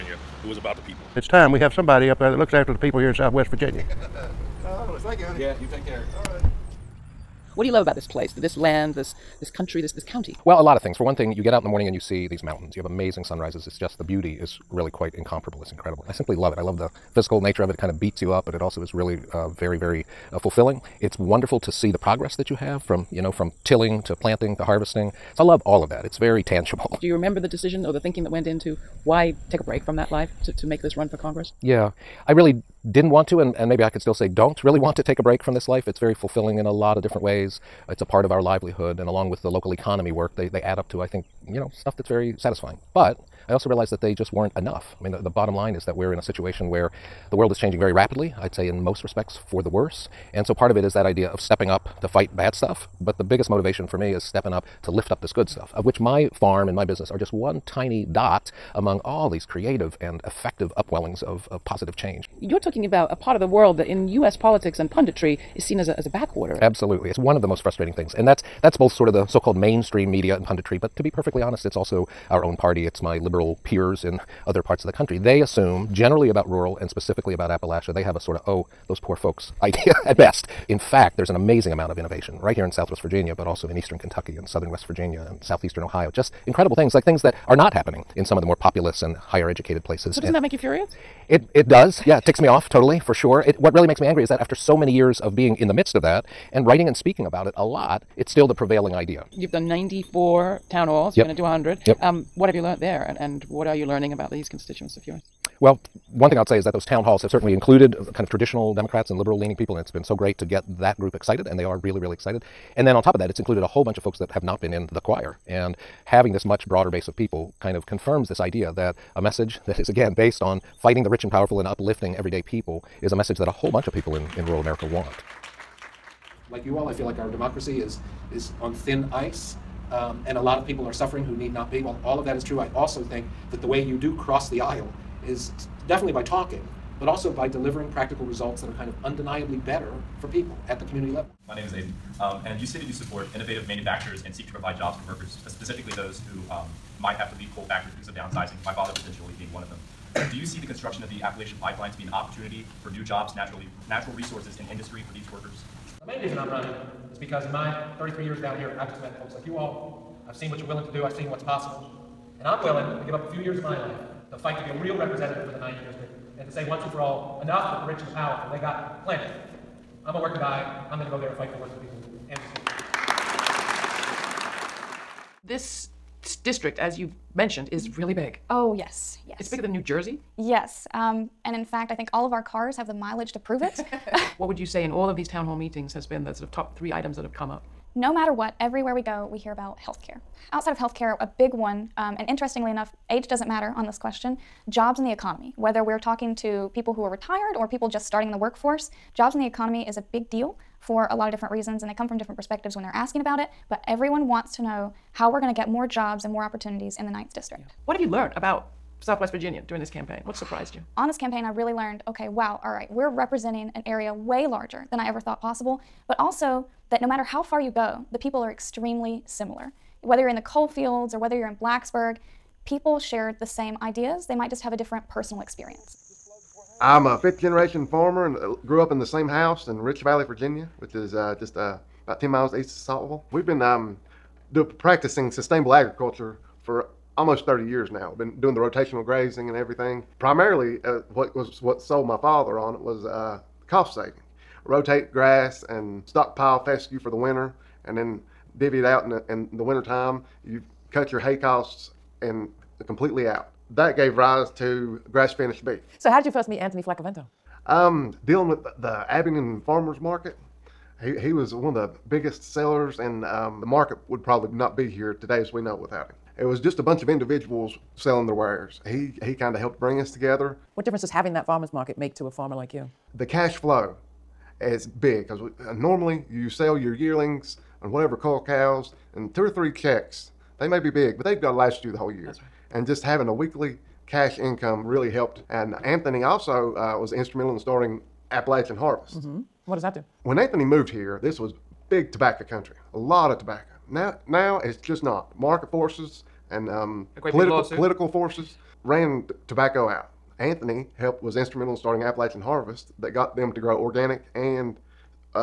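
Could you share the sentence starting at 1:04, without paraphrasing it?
politics and punditry is seen as a, as a backwater.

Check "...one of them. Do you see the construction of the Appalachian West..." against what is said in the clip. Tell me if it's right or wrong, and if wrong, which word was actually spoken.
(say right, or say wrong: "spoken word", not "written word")
wrong: "Pipeline", not "West".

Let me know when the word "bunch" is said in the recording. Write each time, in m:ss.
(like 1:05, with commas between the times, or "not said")
1:53, 2:03, 4:26.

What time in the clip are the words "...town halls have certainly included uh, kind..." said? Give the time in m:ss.
1:46.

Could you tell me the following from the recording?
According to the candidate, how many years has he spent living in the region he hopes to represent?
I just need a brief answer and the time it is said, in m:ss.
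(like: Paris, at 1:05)
33, at 2:37.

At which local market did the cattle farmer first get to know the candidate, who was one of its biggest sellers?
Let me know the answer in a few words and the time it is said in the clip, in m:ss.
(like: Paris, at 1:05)
Abingdon Farmers Market, at 4:19.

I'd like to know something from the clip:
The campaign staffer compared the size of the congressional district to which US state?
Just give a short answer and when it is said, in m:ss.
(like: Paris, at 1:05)
New Jersey, at 2:59.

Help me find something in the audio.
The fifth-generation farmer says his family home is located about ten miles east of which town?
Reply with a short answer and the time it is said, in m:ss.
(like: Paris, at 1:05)
Saltville, at 3:52.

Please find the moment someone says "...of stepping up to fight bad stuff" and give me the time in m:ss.
0:51.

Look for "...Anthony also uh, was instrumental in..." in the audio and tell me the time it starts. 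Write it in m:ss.
4:45.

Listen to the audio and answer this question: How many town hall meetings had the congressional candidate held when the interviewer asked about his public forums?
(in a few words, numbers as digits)
94.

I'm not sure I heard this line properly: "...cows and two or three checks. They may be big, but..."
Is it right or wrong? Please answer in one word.
right.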